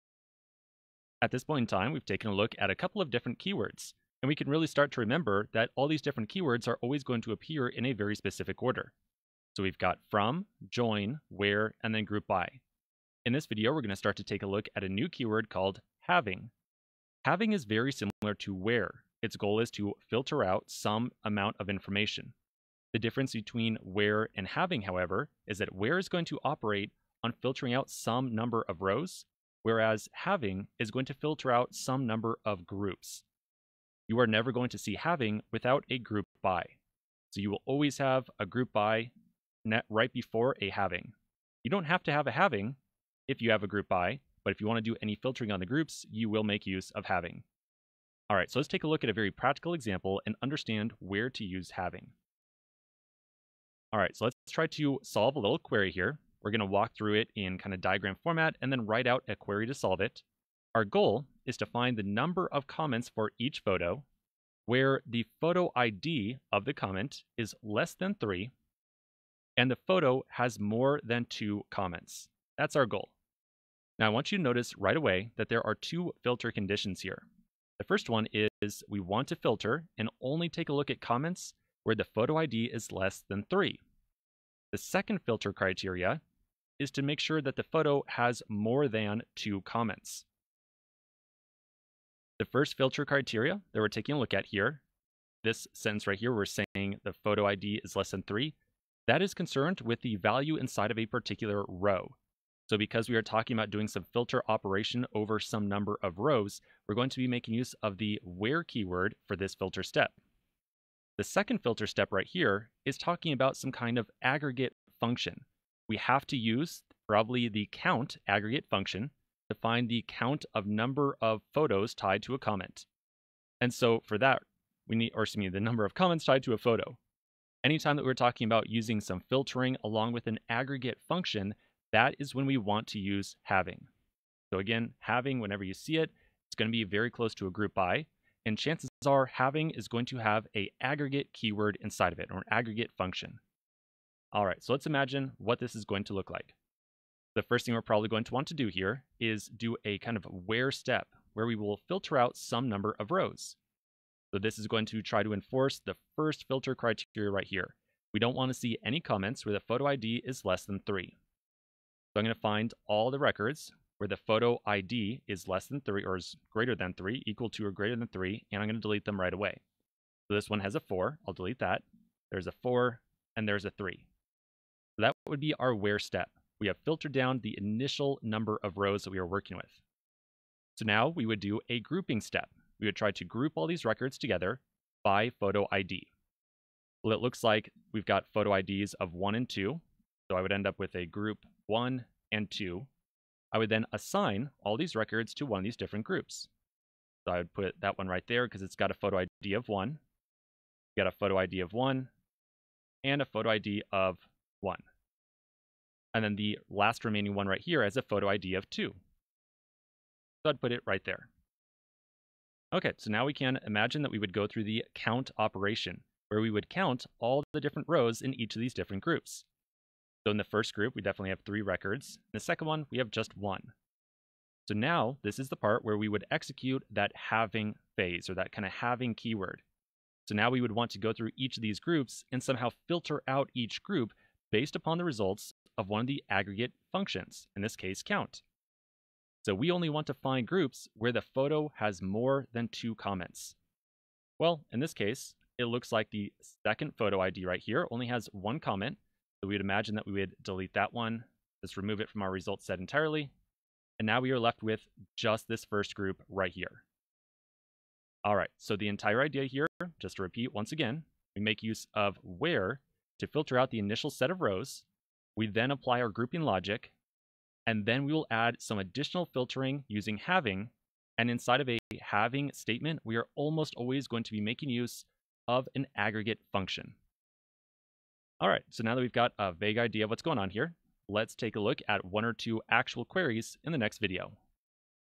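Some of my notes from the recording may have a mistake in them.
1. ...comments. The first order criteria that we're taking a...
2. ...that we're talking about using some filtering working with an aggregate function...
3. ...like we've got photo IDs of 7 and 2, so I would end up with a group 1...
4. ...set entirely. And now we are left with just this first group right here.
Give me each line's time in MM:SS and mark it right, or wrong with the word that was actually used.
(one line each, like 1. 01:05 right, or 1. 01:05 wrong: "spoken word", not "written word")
1. 01:29 wrong: "filter", not "order"
2. 02:07 wrong: "along", not "working"
3. 03:07 wrong: "1", not "7"
4. 04:12 right.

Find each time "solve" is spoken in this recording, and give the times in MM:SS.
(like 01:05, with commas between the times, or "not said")
00:55, 00:59.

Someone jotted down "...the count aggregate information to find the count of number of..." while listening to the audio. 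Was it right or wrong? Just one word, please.
wrong.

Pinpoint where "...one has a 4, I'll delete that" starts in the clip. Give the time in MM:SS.
02:50.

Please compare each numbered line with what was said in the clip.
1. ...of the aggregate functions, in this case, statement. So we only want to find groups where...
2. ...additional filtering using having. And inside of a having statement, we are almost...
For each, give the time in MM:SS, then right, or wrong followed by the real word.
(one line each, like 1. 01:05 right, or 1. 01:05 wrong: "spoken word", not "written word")
1. 03:56 wrong: "count", not "statement"
2. 04:28 right.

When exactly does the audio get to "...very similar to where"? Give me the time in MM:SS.
00:17.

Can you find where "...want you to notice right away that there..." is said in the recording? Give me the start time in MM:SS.
01:14.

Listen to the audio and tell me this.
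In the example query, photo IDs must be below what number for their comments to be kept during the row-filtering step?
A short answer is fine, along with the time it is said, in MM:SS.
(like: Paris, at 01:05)
3, at 01:07.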